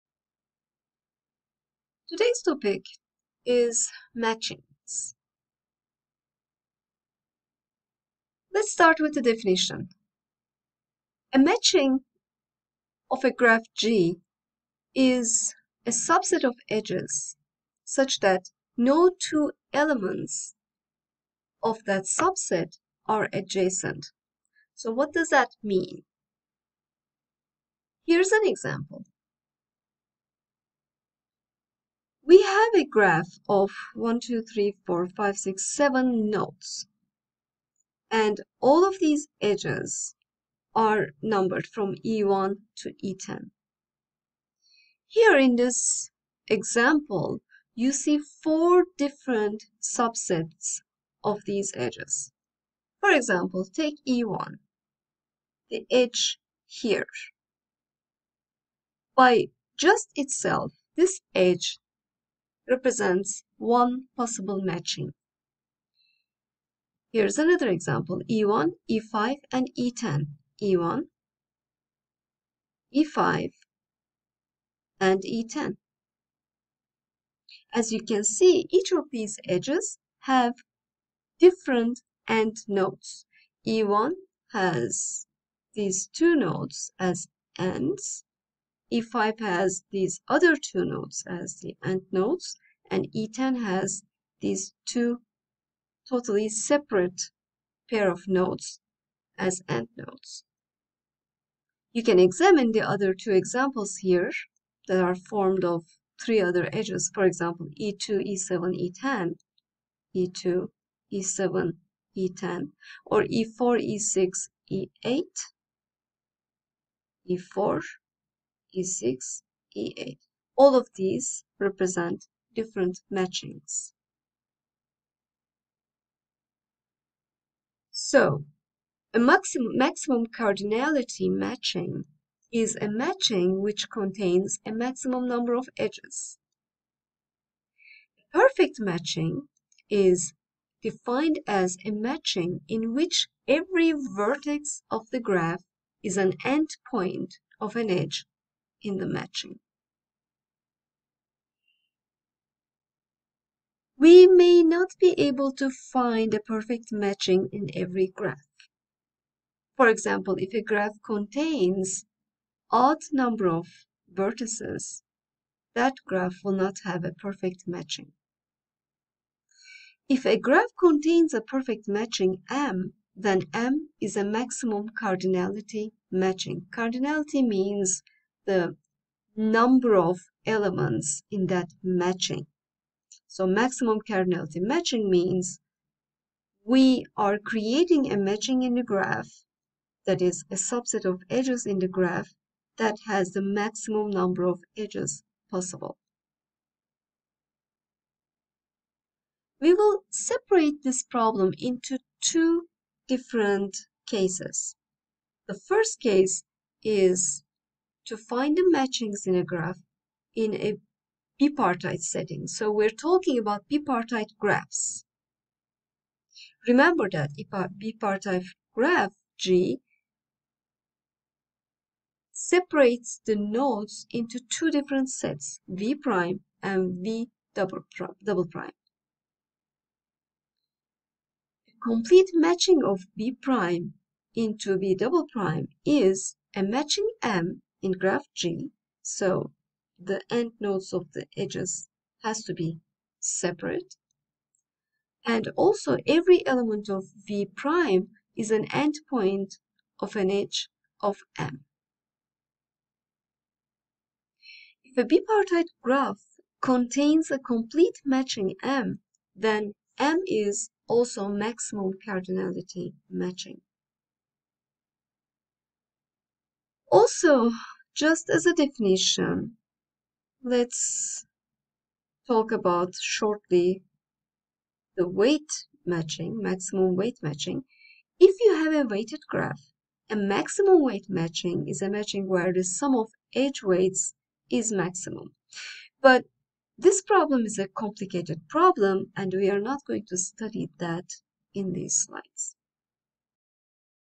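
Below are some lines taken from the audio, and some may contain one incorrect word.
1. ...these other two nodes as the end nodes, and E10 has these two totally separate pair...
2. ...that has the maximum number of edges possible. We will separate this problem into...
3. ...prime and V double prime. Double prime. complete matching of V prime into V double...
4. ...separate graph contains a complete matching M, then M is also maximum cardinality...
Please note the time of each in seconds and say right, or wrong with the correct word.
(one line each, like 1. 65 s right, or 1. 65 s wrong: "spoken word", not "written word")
1. 89 s right
2. 192 s right
3. 225 s right
4. 255 s wrong: "bipartite", not "separate".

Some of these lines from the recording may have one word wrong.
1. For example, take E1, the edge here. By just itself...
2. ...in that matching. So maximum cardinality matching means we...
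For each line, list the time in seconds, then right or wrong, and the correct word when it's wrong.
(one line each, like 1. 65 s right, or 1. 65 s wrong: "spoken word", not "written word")
1. 53 s right
2. 181 s right.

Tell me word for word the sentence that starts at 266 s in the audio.
Also, just as a definition, let's talk about shortly the weight matching, maximum weight matching.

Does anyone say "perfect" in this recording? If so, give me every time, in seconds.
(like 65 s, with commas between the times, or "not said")
138 s, 156 s, 167 s, 171 s.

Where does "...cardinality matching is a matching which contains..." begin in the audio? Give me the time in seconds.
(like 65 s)
130 s.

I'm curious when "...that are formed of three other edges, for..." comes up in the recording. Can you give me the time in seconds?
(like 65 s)
104 s.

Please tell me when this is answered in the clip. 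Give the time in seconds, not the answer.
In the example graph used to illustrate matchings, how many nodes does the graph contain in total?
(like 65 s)
35 s.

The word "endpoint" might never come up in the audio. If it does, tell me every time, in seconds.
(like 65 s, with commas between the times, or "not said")
146 s, 248 s.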